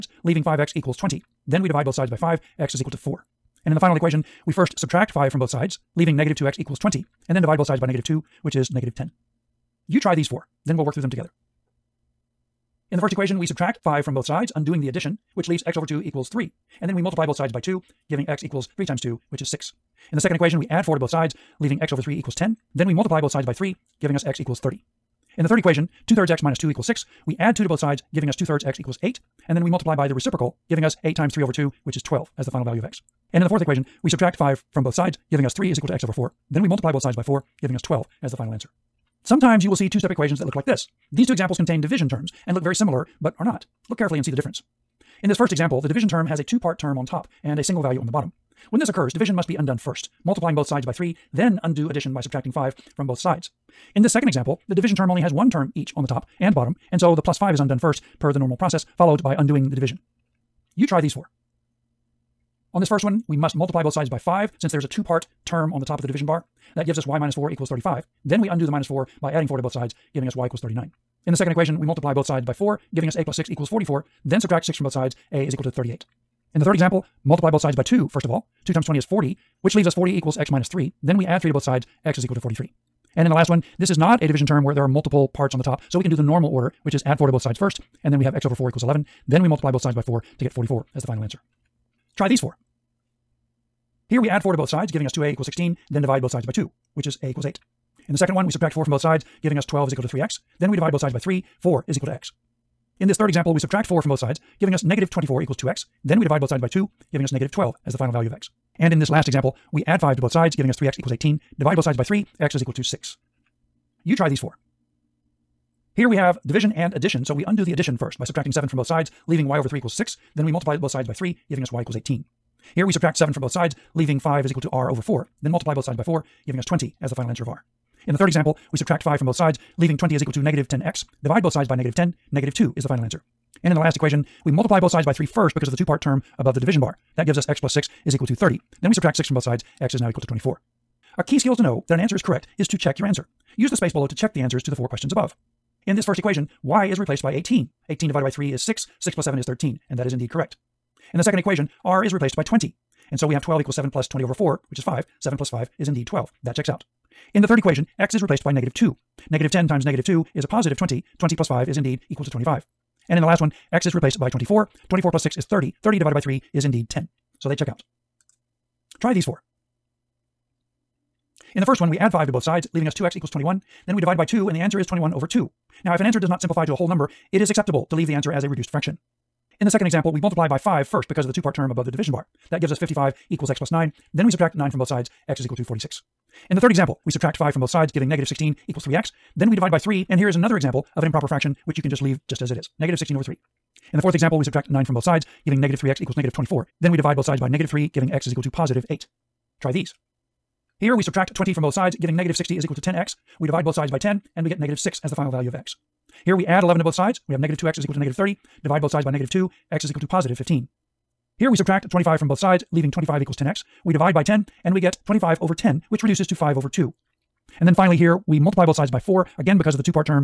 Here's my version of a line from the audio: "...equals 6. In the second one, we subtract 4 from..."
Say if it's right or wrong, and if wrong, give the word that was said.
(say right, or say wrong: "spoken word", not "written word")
wrong: "8", not "6".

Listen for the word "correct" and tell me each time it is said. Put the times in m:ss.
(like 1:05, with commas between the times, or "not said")
2:22, 2:30.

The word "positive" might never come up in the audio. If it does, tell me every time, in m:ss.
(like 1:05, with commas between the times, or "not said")
2:40, 3:18, 3:30.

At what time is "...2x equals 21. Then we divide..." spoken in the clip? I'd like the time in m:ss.
2:52.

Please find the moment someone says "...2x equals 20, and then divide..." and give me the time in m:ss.
0:06.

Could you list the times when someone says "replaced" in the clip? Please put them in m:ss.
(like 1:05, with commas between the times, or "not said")
2:26, 2:32, 2:38, 2:43.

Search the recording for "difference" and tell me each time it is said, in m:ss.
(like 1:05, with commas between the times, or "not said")
0:44.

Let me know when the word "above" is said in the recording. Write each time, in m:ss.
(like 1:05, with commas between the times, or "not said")
2:16, 2:25, 3:01.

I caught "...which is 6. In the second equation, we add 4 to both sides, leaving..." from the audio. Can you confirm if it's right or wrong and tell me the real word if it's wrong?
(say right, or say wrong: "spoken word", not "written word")
right.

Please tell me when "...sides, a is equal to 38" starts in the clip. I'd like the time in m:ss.
1:14.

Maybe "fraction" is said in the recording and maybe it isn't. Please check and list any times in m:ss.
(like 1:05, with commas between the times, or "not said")
2:58, 3:11.